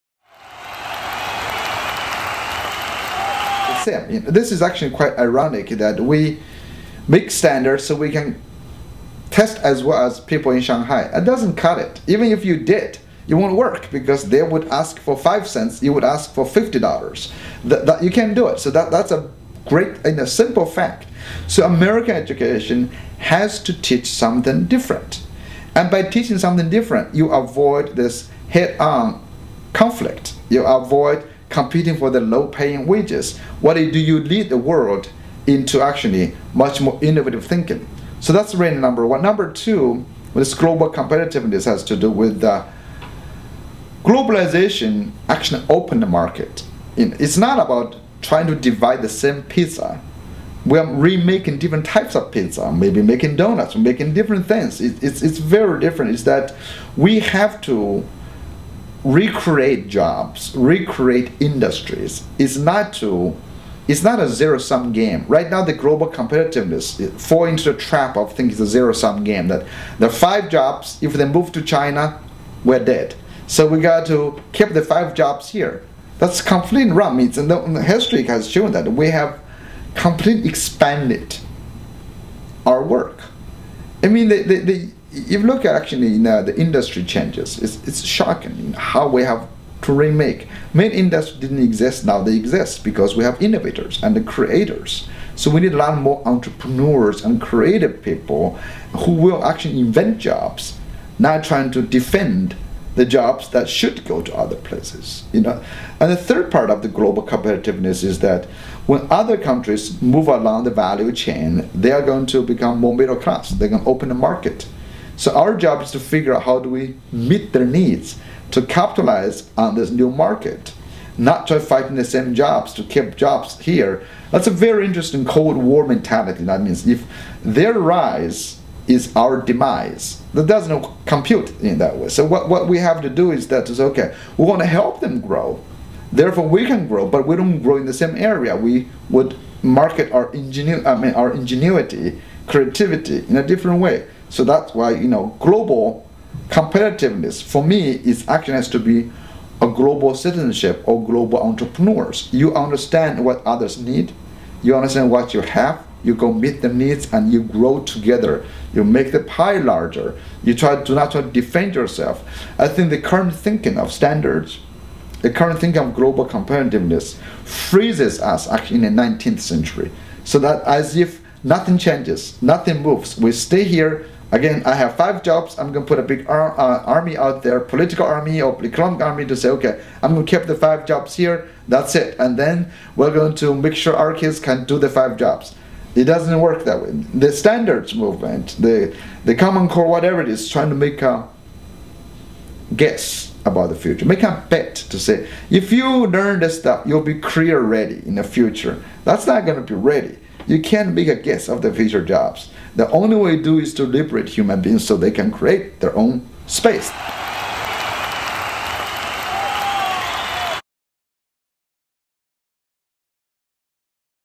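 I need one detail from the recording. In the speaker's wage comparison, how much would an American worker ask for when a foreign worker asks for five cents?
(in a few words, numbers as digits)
$50.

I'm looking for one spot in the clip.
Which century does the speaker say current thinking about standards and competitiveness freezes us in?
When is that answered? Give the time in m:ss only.
2:49.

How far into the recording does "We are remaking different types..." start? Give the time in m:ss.
0:50.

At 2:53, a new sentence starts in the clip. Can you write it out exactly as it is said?
We stay here Again, I have five jobs.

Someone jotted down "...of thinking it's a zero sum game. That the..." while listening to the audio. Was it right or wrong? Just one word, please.
right.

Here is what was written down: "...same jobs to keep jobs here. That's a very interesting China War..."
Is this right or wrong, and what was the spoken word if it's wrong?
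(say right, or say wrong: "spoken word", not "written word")
wrong: "Cold", not "China".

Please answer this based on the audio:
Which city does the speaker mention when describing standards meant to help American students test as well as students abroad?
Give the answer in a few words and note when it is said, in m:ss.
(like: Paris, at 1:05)
Shanghai, at 0:10.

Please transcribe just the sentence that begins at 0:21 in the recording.
So American education has to teach something different.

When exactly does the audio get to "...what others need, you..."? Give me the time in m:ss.
2:33.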